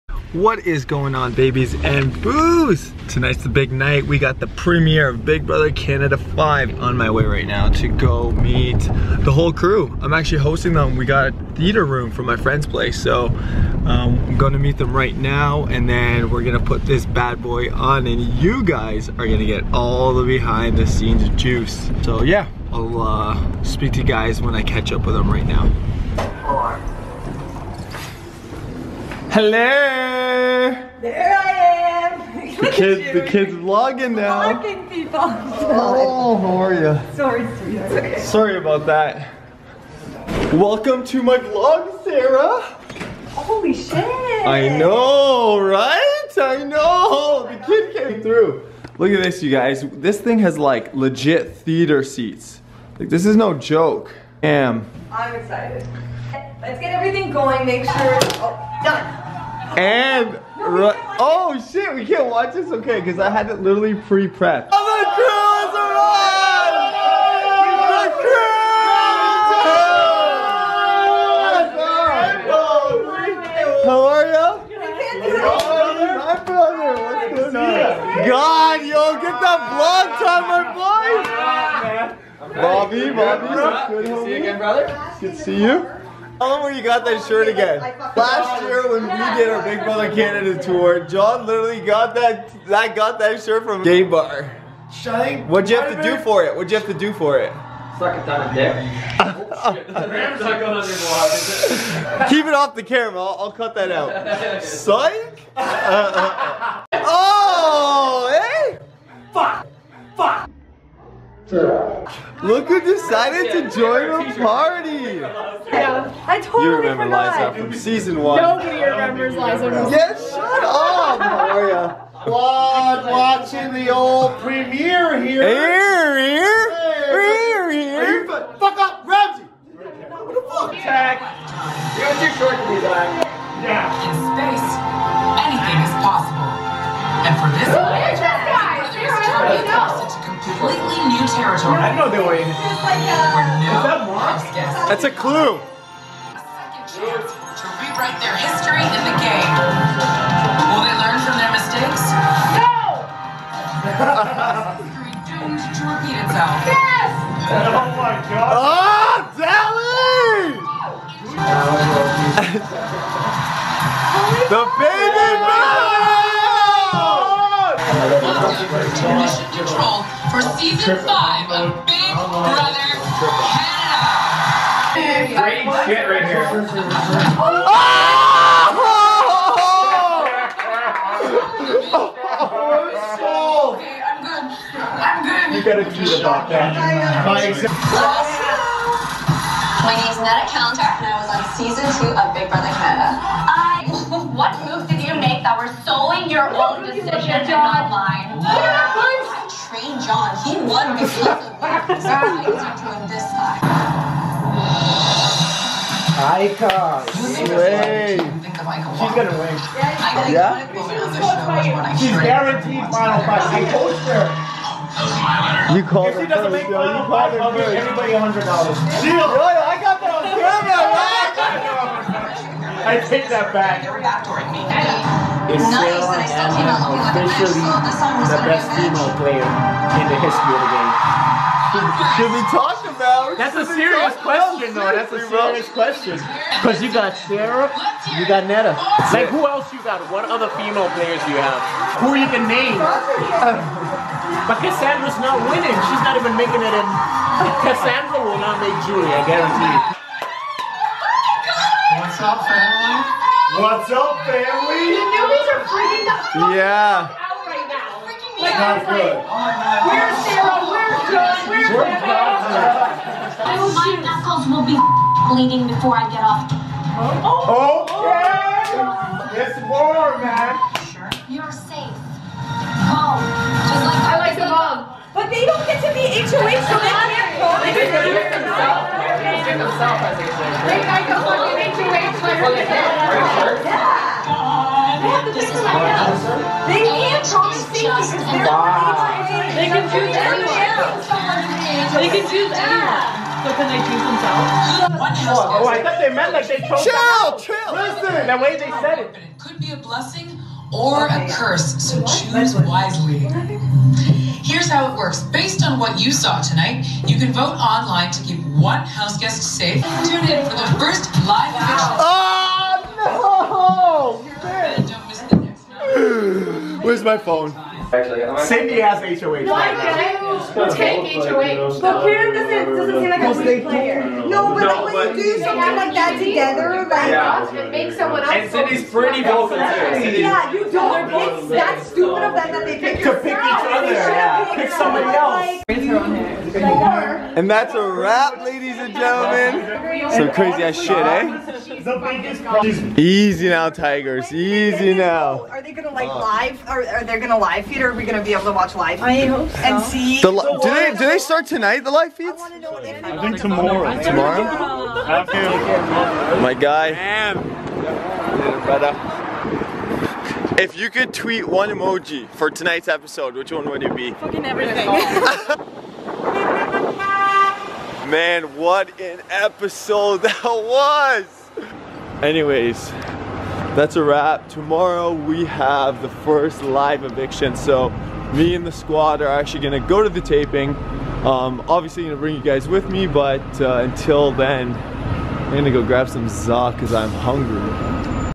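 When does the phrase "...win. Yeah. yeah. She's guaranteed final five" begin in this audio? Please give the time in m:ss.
3:29.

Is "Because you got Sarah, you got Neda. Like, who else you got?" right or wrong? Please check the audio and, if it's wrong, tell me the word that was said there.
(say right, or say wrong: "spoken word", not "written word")
right.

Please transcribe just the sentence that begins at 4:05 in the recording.
She's not even making it in.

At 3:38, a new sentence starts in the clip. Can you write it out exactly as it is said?
Shield, I got that on camera, man.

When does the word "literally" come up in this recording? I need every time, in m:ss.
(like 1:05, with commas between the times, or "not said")
1:03, 1:31.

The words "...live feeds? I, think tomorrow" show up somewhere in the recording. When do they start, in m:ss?
5:51.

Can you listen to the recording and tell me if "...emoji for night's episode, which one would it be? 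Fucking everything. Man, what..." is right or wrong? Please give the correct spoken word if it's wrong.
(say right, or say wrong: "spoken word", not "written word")
wrong: "tonight", not "night".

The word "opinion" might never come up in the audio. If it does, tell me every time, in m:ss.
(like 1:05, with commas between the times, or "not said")
not said.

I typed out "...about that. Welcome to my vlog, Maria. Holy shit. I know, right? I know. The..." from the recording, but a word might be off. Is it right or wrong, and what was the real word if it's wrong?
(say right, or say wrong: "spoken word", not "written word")
wrong: "Sarah", not "Maria".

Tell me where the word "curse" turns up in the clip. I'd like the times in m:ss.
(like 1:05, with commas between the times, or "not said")
5:01.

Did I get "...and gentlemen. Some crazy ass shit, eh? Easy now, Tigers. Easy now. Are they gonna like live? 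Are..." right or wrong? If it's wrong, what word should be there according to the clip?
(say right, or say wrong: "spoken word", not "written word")
right.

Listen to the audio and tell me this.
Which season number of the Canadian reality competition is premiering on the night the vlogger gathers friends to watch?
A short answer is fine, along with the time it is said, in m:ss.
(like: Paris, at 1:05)
5, at 0:05.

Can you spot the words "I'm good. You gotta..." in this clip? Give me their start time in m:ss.
3:04.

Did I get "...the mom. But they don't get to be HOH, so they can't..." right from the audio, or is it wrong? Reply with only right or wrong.
right.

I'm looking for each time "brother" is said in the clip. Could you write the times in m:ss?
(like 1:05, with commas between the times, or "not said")
0:05, 1:16, 1:29, 2:52, 3:12.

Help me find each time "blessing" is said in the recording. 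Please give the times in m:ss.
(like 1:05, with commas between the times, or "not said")
4:59.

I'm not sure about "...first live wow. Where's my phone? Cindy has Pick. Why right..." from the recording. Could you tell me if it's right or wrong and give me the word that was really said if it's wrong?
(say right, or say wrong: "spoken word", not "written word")
wrong: "HOH", not "Pick".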